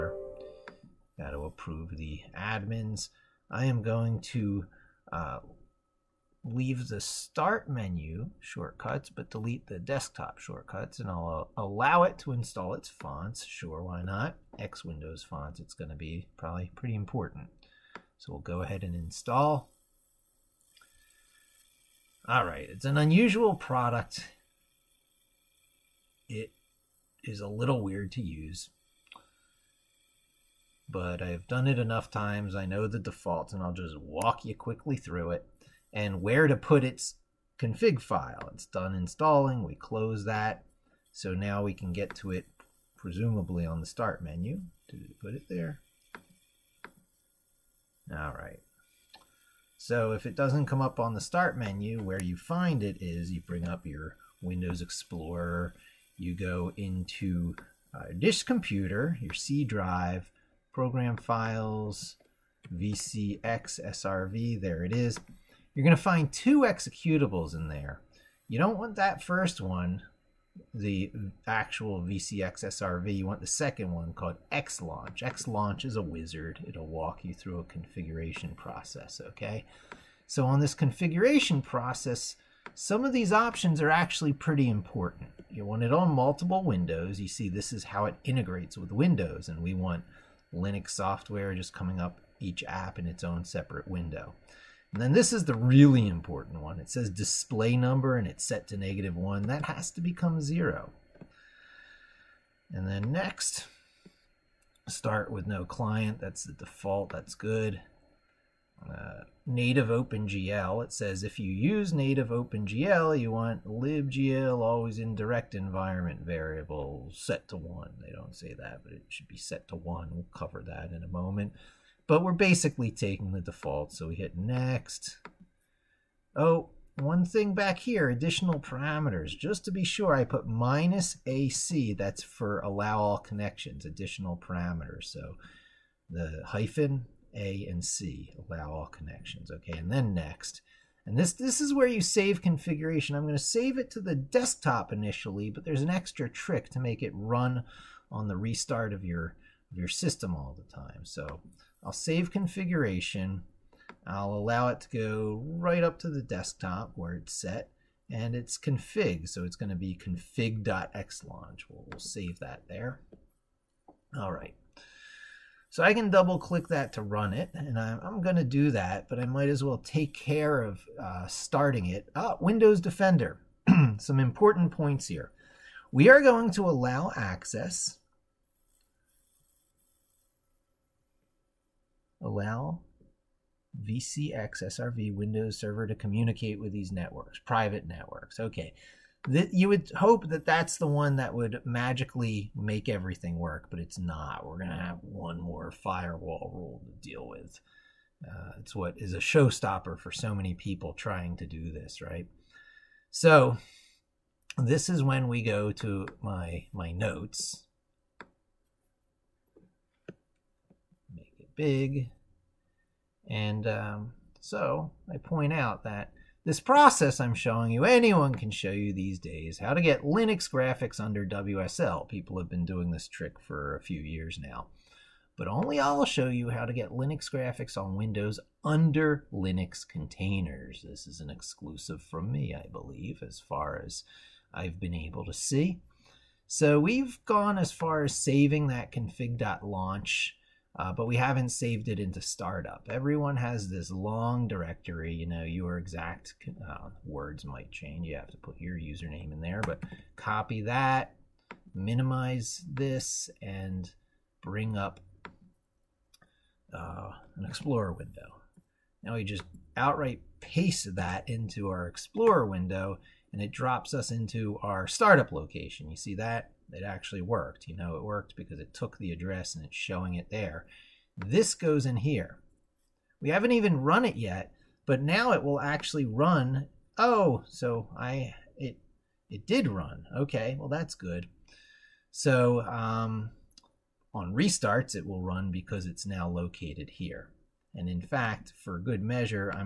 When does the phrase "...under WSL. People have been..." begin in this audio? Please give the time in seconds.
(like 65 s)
220 s.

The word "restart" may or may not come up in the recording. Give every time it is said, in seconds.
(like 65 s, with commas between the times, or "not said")
148 s, 284 s.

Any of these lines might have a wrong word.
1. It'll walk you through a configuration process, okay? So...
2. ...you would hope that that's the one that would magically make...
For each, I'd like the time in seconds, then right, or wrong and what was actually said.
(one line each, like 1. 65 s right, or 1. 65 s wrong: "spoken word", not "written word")
1. 76 s right
2. 189 s right.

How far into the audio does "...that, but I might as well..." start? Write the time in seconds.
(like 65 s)
168 s.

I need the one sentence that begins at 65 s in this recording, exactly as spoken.
You're going to find two executables in there.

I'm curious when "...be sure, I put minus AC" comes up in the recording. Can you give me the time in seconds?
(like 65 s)
129 s.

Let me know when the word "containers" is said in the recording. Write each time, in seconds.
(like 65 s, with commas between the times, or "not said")
229 s.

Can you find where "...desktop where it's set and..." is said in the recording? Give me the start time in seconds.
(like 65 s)
156 s.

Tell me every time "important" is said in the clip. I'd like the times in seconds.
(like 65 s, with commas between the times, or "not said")
16 s, 84 s, 96 s, 174 s.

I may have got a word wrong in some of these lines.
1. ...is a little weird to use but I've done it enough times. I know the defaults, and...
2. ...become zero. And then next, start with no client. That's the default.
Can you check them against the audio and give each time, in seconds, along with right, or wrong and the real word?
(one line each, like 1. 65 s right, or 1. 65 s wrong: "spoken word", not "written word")
1. 27 s right
2. 99 s right.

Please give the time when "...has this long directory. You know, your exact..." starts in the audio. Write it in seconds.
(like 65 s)
243 s.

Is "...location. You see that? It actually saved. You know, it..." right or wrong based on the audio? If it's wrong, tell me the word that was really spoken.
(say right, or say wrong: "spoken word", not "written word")
wrong: "worked", not "saved".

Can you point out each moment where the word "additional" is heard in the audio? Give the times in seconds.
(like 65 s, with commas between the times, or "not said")
128 s, 133 s.